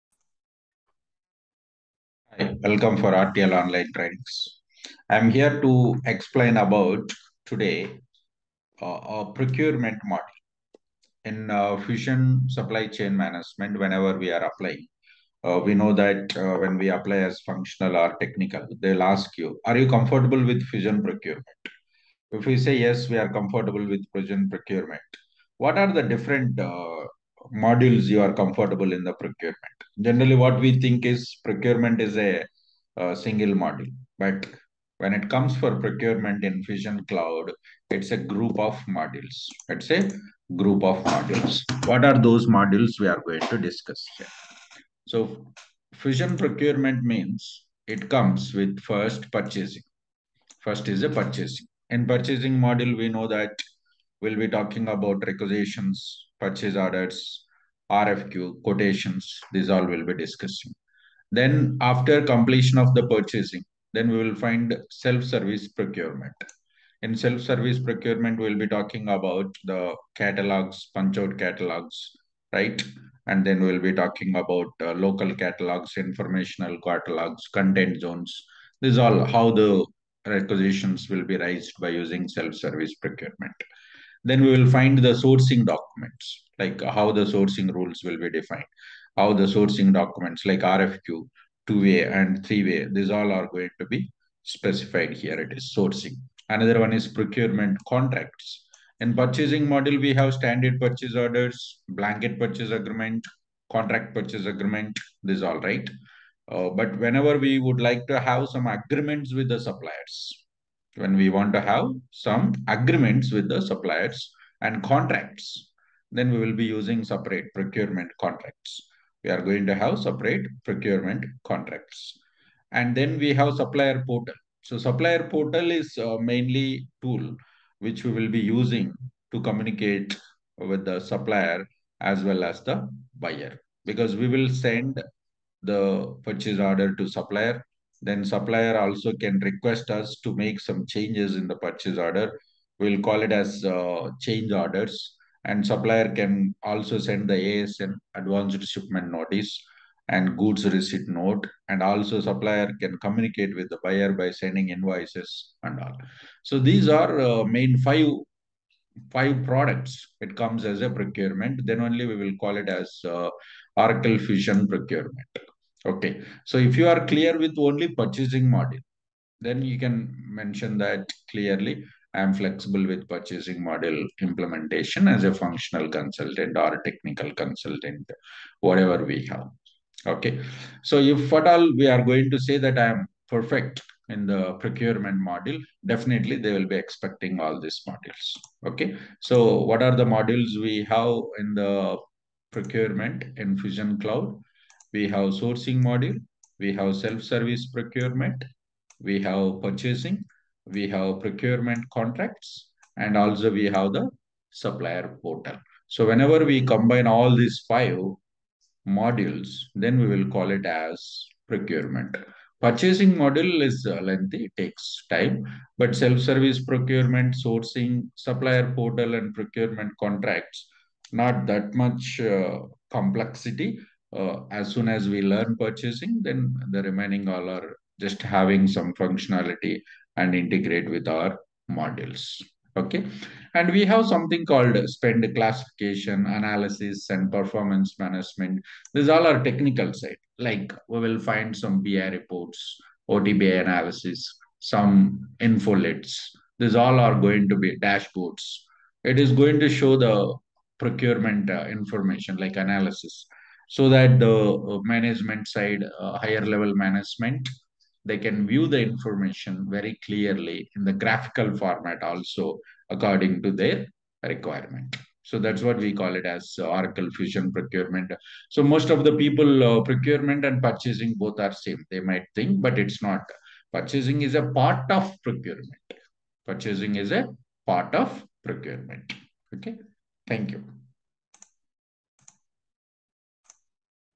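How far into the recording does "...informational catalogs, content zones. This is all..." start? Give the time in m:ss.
1:15.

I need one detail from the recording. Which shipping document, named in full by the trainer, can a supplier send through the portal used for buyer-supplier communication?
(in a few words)
Advanced shipment notice.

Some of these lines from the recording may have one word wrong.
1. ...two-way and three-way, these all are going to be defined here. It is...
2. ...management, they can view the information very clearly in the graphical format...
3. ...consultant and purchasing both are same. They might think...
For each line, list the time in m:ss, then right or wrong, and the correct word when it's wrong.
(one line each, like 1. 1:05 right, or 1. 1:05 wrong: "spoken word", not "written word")
1. 1:31 wrong: "specified", not "defined"
2. 4:16 right
3. 4:29 wrong: "procurement", not "consultant".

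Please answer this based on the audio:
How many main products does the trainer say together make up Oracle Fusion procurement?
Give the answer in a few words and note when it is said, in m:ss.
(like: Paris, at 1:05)
5, at 2:37.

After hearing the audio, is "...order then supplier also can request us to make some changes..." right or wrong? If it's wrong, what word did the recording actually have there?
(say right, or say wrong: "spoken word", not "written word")
wrong: "supplier", not "order".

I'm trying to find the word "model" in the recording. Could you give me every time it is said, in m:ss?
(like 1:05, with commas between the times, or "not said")
0:10, 1:39, 2:48, 2:53, 3:05.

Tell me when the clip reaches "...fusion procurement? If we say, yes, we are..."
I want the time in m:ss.
0:20.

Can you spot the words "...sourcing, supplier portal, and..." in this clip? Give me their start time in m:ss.
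3:37.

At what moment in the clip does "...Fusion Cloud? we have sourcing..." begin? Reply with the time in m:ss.
3:13.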